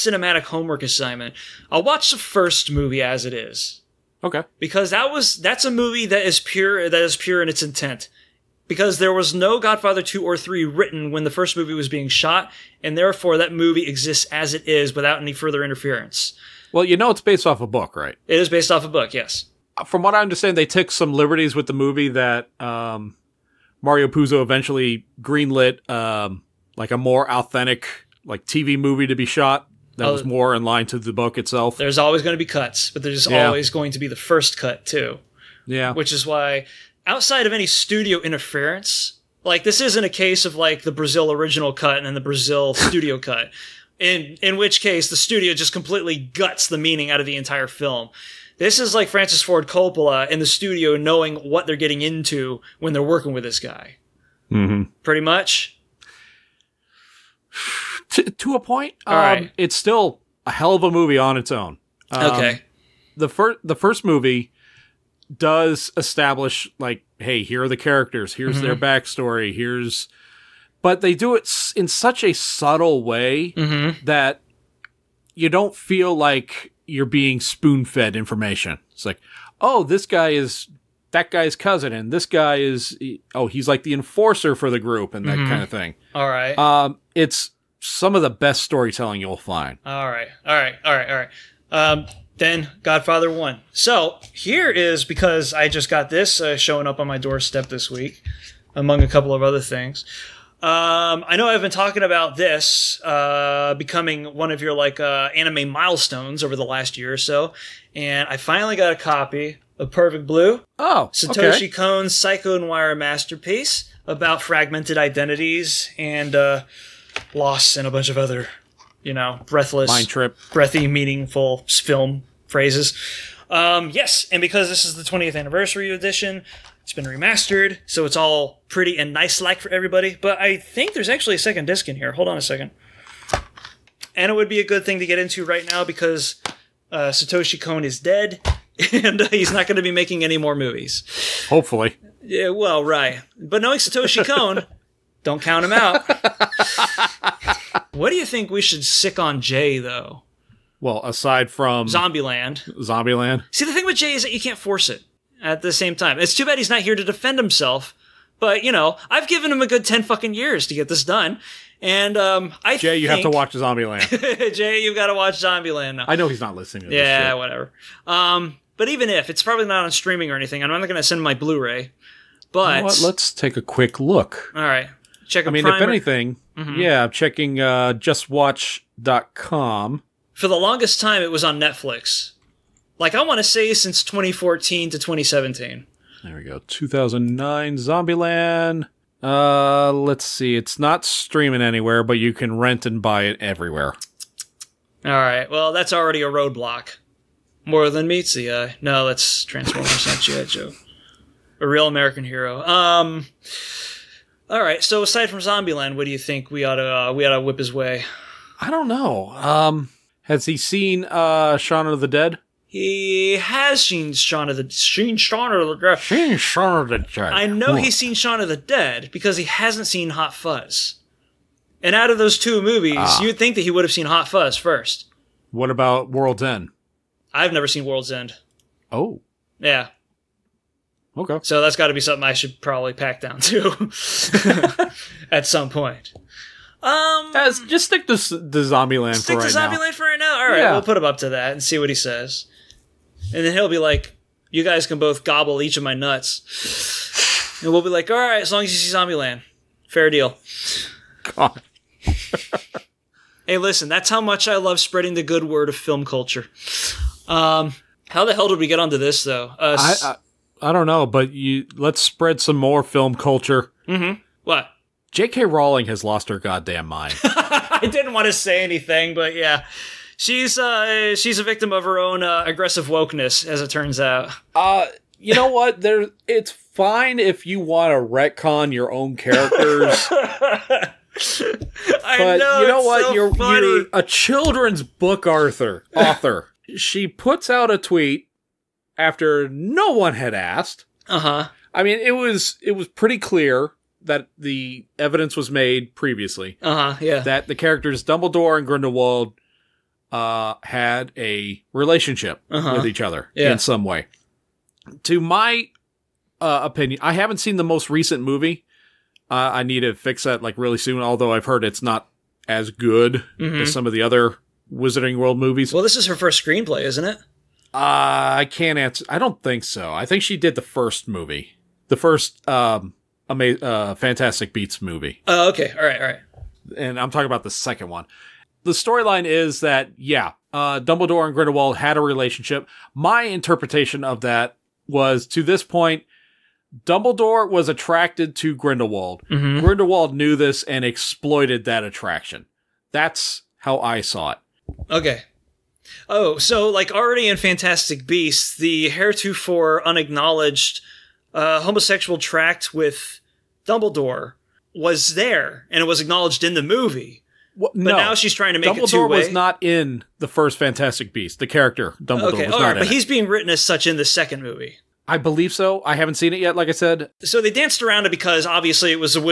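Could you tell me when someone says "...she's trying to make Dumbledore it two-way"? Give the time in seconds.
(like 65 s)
358 s.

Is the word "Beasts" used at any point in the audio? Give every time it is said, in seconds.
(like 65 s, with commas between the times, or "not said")
324 s, 348 s, 361 s.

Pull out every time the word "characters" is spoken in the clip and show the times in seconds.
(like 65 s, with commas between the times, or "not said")
67 s, 279 s, 297 s, 361 s.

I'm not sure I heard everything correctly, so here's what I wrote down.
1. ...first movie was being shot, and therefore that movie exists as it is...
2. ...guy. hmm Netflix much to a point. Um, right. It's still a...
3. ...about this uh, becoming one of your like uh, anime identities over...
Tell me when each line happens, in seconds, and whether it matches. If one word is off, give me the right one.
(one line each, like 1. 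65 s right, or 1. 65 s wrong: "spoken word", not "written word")
1. 11 s right
2. 53 s wrong: "Pretty", not "Netflix"
3. 102 s wrong: "milestones", not "identities".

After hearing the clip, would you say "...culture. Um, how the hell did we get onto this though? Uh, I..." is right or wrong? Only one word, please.
right.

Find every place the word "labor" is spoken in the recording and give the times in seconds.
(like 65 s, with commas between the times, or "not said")
not said.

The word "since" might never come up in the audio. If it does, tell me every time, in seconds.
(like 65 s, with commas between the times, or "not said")
183 s.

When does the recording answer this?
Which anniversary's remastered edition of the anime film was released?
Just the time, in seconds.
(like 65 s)
125 s.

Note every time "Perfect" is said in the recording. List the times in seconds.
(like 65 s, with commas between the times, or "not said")
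109 s.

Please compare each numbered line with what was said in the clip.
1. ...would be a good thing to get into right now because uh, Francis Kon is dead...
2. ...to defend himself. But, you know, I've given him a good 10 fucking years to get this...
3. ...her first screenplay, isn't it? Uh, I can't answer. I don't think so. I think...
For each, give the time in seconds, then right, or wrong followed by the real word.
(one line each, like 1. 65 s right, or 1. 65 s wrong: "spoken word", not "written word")
1. 134 s wrong: "Satoshi", not "Francis"
2. 156 s right
3. 316 s right.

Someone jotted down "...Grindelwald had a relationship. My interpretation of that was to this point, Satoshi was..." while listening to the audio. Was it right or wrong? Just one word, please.
wrong.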